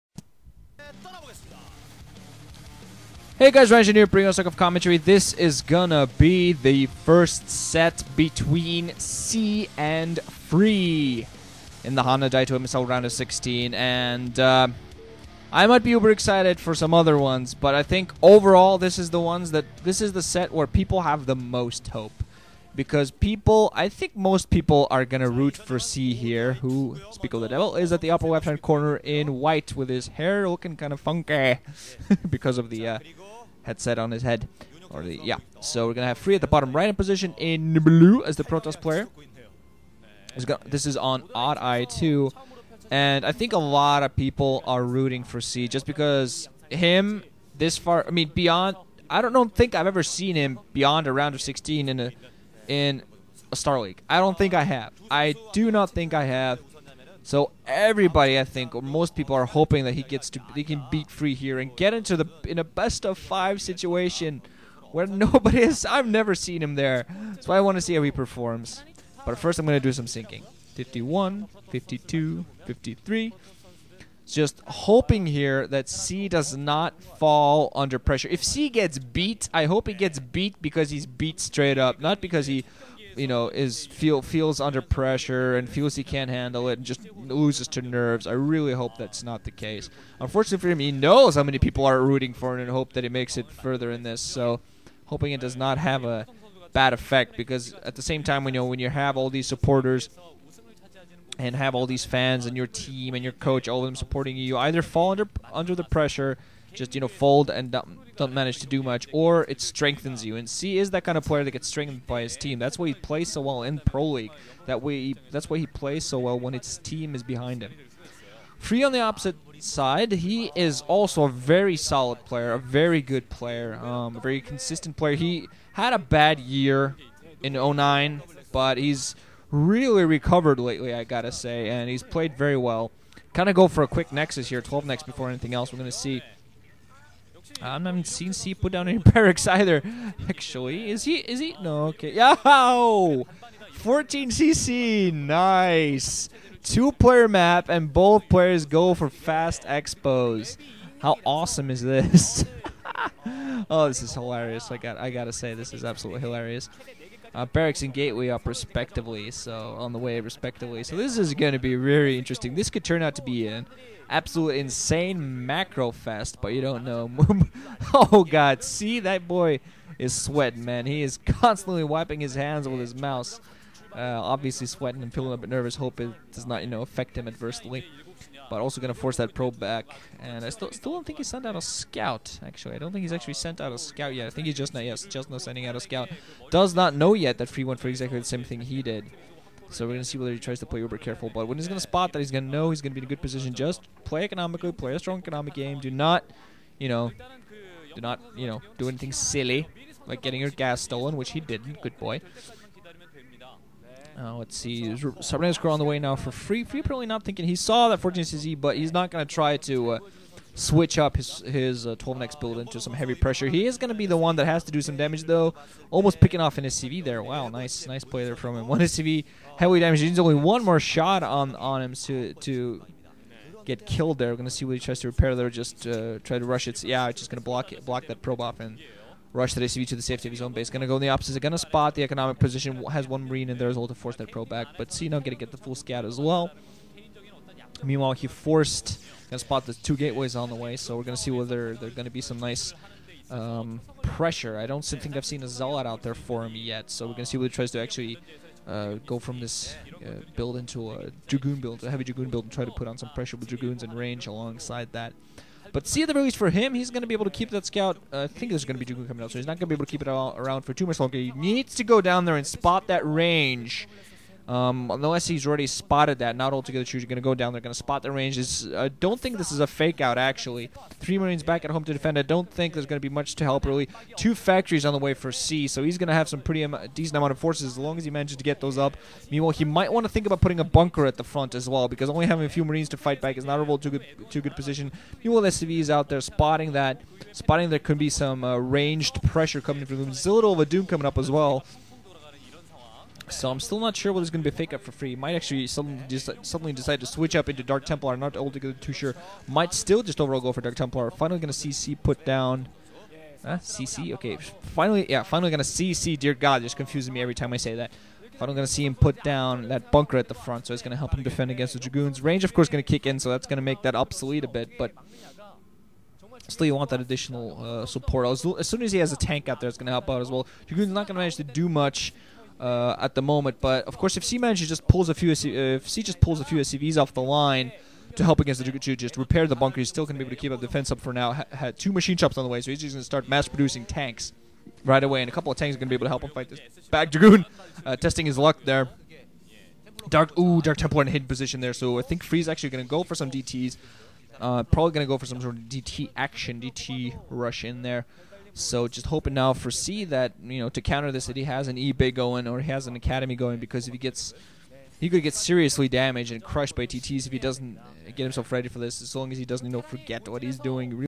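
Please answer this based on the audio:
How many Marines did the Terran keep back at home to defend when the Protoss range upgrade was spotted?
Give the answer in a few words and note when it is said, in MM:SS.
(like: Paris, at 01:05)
3, at 04:30.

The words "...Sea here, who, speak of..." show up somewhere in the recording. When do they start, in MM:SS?
00:25.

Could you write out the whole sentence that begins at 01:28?
I really hope that's not the case.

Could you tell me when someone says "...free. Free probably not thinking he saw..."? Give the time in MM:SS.
03:26.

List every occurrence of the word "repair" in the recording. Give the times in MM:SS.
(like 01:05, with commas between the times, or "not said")
03:45, 05:29.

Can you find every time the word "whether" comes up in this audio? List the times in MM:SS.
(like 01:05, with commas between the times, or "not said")
03:10, 04:01.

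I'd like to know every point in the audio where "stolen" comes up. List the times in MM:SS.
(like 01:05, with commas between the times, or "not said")
03:20.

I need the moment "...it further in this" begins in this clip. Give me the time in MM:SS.
01:33.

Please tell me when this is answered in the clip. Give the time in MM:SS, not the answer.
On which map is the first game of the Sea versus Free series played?
00:41.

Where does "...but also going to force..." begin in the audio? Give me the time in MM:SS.
02:58.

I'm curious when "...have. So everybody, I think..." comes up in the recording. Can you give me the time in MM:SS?
00:56.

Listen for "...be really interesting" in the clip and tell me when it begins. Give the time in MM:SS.
02:41.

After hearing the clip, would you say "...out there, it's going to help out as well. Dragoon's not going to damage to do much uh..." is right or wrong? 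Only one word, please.
wrong.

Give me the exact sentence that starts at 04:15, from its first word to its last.
But see the release for him, he's going to be able to keep that scout.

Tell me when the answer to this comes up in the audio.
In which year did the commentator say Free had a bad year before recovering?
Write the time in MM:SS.
02:07.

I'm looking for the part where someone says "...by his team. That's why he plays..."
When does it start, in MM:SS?
01:52.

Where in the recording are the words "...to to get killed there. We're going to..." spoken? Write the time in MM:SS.
03:41.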